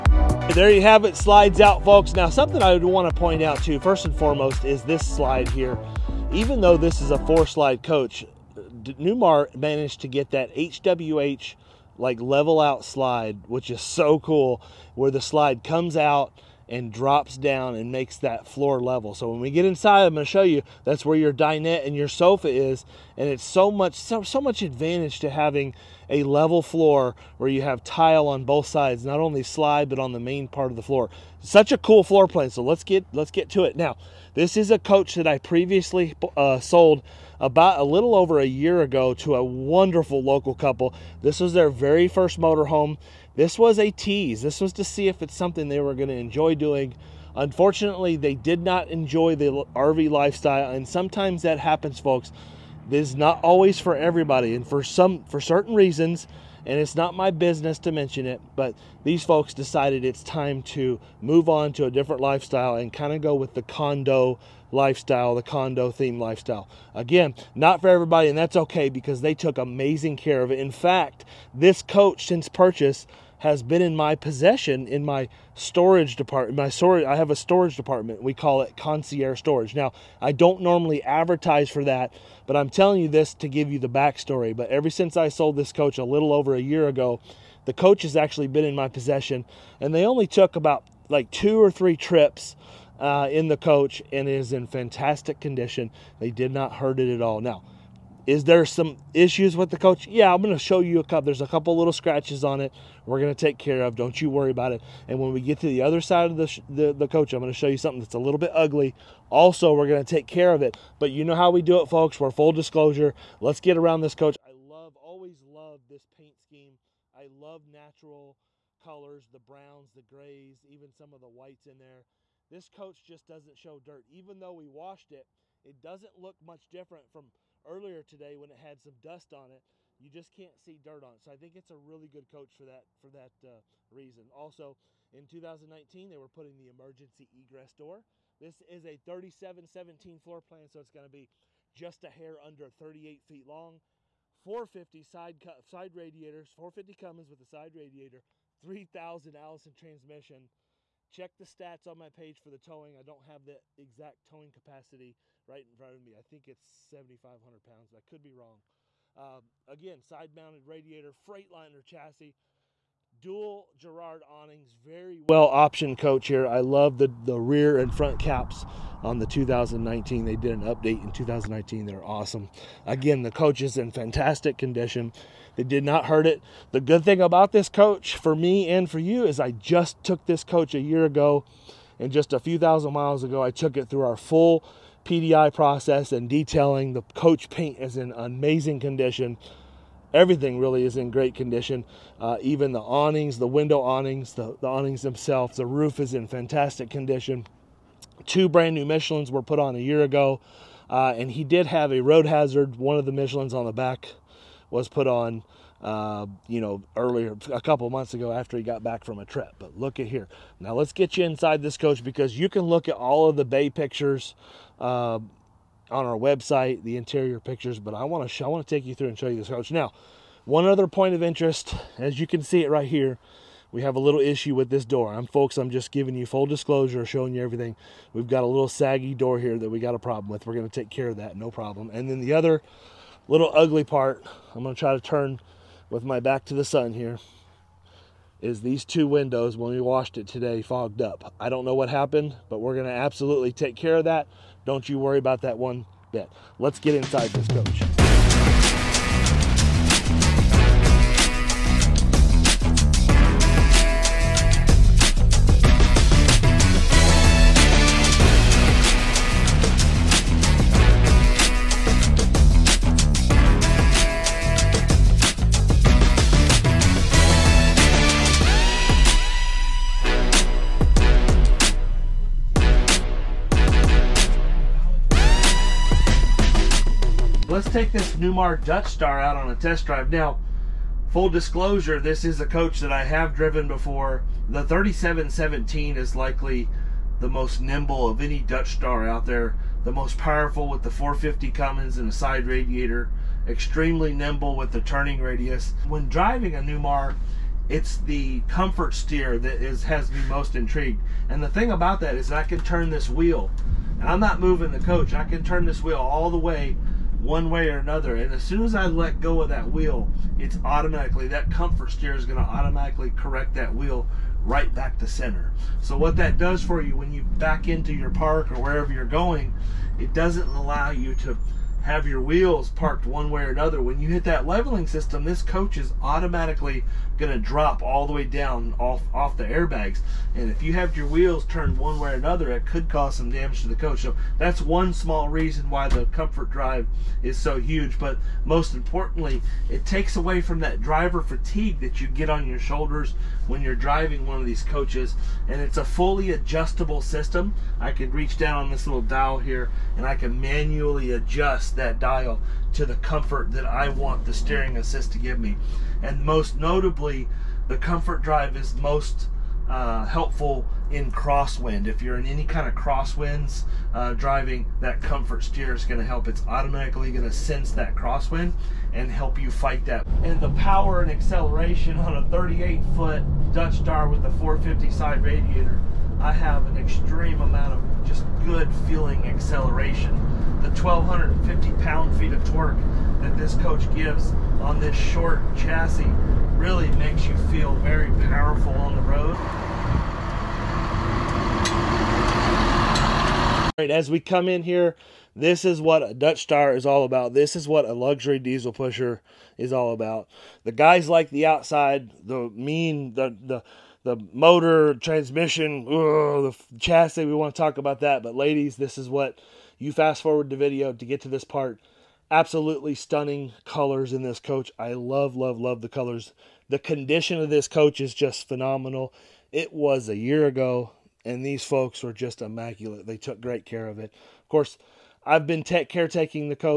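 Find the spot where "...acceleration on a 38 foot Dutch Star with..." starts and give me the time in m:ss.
6:11.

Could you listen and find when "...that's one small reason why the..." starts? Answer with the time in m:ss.
5:34.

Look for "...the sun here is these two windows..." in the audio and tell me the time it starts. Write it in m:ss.
3:56.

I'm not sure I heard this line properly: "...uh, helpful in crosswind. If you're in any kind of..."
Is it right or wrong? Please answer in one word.
right.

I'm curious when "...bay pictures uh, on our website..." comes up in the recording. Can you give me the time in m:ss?
3:33.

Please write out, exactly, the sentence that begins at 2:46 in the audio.
I love the, the rear and front caps on the 2019.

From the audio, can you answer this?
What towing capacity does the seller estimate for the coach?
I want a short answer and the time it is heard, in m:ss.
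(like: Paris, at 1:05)
7,500 pounds, at 2:36.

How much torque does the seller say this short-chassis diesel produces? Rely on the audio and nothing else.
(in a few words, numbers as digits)
1,250 pound-feet.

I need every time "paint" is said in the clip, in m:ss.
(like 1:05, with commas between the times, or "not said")
1:56, 3:07.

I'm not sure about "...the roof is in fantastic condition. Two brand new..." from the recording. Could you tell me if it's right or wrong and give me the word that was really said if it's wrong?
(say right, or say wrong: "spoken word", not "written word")
right.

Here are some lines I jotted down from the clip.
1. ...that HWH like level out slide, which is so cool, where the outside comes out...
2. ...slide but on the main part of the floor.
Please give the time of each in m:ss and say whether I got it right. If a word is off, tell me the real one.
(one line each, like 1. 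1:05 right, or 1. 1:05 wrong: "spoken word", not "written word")
1. 0:10 wrong: "slide", not "outside"
2. 0:29 right.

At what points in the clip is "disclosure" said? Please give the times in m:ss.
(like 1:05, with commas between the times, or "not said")
1:52, 3:46, 4:41.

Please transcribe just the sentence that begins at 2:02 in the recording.
This coach just doesn't show dirt.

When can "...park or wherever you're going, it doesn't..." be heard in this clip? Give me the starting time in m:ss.
5:18.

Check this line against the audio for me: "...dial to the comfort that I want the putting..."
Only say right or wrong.
wrong.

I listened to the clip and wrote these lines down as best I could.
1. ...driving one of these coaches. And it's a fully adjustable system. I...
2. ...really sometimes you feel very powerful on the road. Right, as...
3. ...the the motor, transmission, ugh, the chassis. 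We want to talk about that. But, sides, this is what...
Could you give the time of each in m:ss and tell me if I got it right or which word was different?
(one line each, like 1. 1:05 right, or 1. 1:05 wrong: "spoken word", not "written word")
1. 5:43 right
2. 6:26 wrong: "makes", not "sometimes"
3. 6:43 wrong: "ladies", not "sides".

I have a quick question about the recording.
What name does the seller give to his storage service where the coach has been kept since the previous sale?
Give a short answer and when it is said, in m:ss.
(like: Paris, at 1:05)
concierge storage, at 1:18.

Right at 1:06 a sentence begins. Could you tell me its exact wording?
Again, not for everybody, and that's okay because they took amazing care of it.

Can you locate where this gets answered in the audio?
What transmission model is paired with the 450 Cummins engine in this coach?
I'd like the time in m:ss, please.
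2:28.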